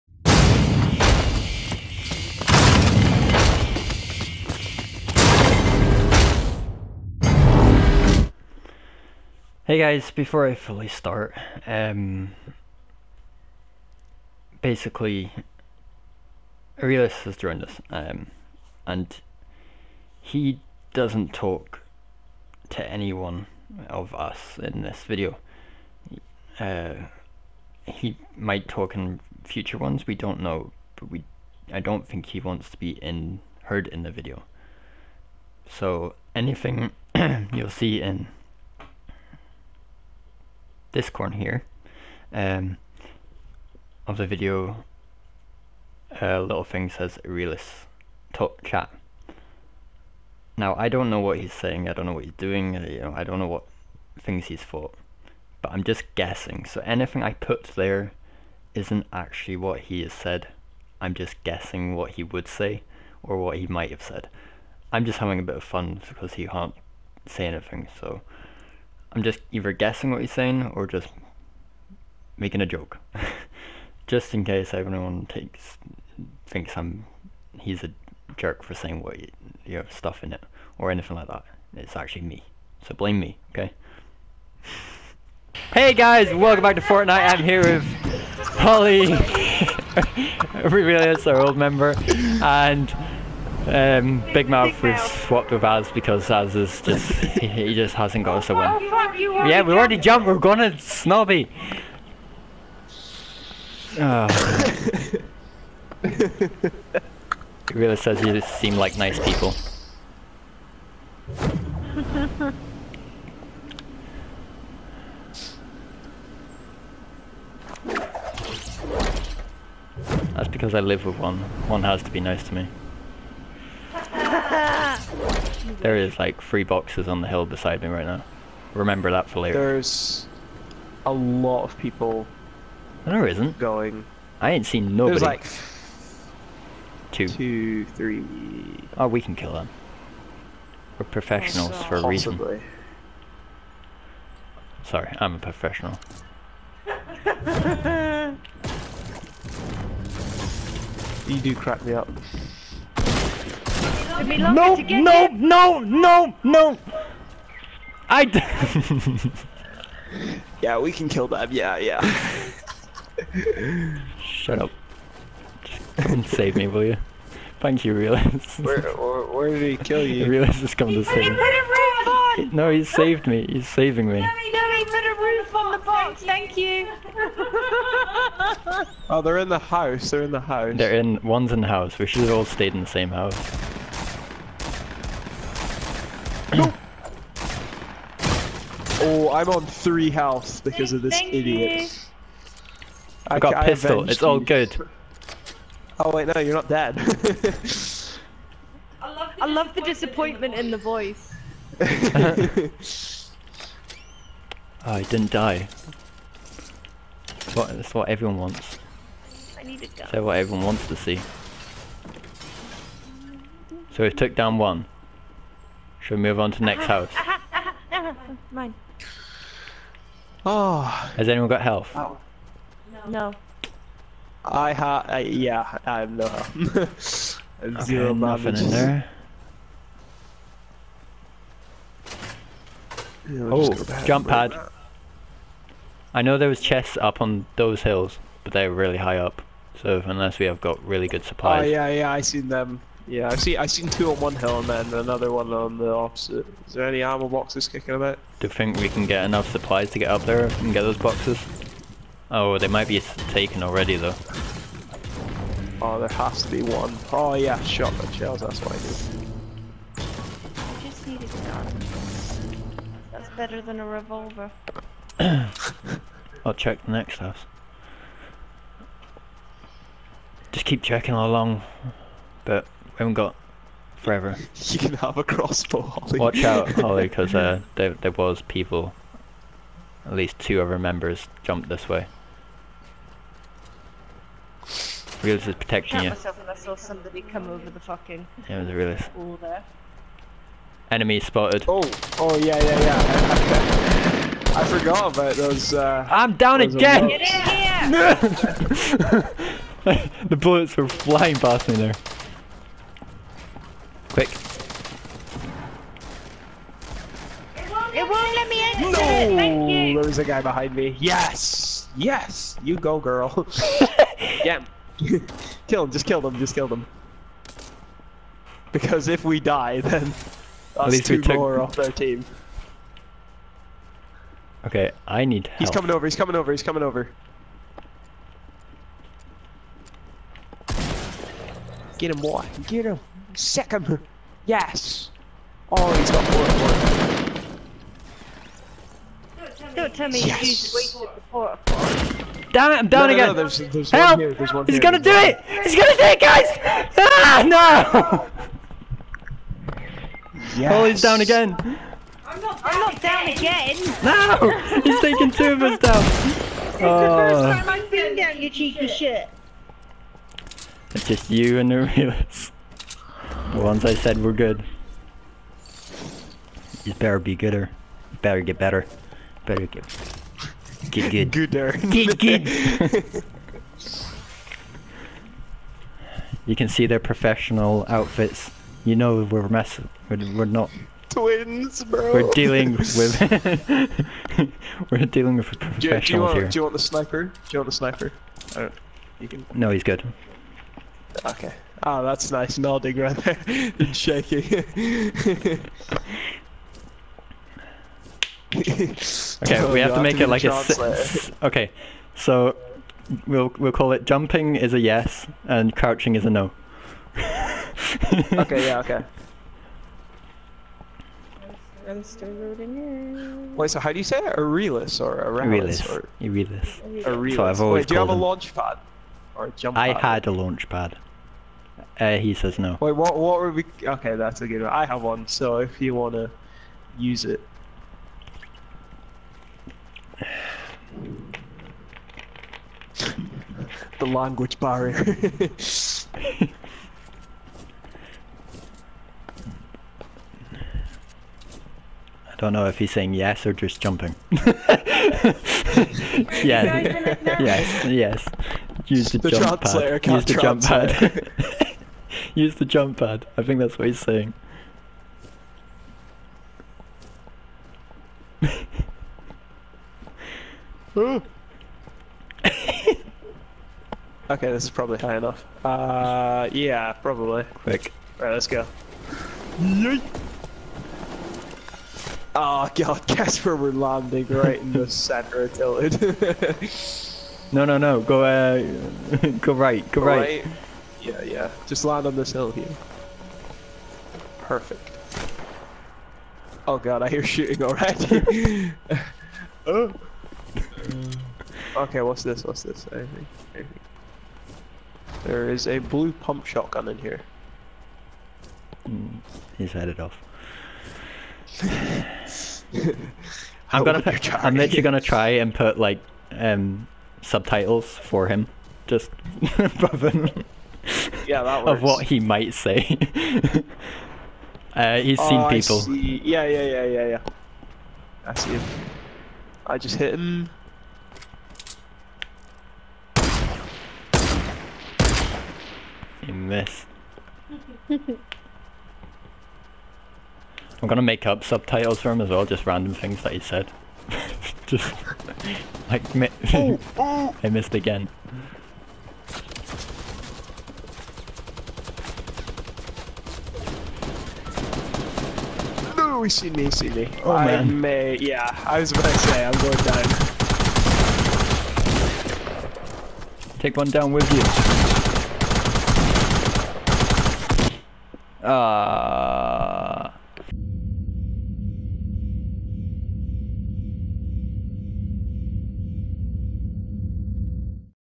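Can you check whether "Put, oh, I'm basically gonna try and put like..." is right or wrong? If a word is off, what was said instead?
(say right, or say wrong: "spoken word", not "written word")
wrong: "literally", not "basically".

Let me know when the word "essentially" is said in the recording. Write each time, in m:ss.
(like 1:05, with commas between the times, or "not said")
not said.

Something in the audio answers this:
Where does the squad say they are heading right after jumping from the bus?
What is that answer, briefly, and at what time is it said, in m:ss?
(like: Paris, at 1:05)
Snobby, at 1:40.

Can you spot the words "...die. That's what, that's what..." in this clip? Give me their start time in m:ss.
3:25.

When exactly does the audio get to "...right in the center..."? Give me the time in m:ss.
7:54.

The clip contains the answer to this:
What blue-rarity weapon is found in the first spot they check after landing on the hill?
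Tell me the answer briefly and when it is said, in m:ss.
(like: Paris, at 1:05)
pump shotgun, at 8:16.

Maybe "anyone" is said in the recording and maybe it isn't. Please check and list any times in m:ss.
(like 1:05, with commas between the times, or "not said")
0:22, 3:41.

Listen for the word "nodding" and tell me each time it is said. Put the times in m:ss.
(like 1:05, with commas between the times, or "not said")
6:32.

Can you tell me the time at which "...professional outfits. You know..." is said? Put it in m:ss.
6:16.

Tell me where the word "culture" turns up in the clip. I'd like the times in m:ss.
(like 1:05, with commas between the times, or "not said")
not said.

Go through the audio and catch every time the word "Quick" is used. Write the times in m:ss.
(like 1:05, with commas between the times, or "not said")
5:04, 7:47.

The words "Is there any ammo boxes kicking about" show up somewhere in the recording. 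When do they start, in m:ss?
4:06.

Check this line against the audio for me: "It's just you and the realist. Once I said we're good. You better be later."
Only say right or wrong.
wrong.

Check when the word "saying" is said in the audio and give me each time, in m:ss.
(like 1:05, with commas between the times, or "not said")
0:51, 1:10, 1:18, 7:22, 7:33.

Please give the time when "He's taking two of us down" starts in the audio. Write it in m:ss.
5:54.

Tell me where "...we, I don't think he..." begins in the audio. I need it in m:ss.
0:31.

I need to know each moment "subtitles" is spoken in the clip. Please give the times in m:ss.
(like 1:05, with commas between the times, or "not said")
8:27, 8:51.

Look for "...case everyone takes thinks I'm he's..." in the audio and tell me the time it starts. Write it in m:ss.
1:14.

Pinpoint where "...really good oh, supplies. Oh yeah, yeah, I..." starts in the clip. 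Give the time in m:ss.
4:00.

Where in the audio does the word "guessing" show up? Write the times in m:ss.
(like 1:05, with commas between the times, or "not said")
0:56, 1:01, 1:09.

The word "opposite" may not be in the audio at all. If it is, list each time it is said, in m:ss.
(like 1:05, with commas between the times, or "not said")
4:05.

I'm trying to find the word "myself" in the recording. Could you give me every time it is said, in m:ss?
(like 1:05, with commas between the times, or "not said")
4:46.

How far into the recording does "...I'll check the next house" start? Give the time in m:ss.
4:26.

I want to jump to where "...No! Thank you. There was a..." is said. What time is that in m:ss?
5:08.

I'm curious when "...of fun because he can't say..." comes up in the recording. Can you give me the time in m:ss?
1:05.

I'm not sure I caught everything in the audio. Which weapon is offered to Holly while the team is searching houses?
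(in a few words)
crossbow.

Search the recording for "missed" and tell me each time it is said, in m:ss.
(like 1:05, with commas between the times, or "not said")
8:46, 8:57.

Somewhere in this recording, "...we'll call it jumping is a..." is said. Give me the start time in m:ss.
6:43.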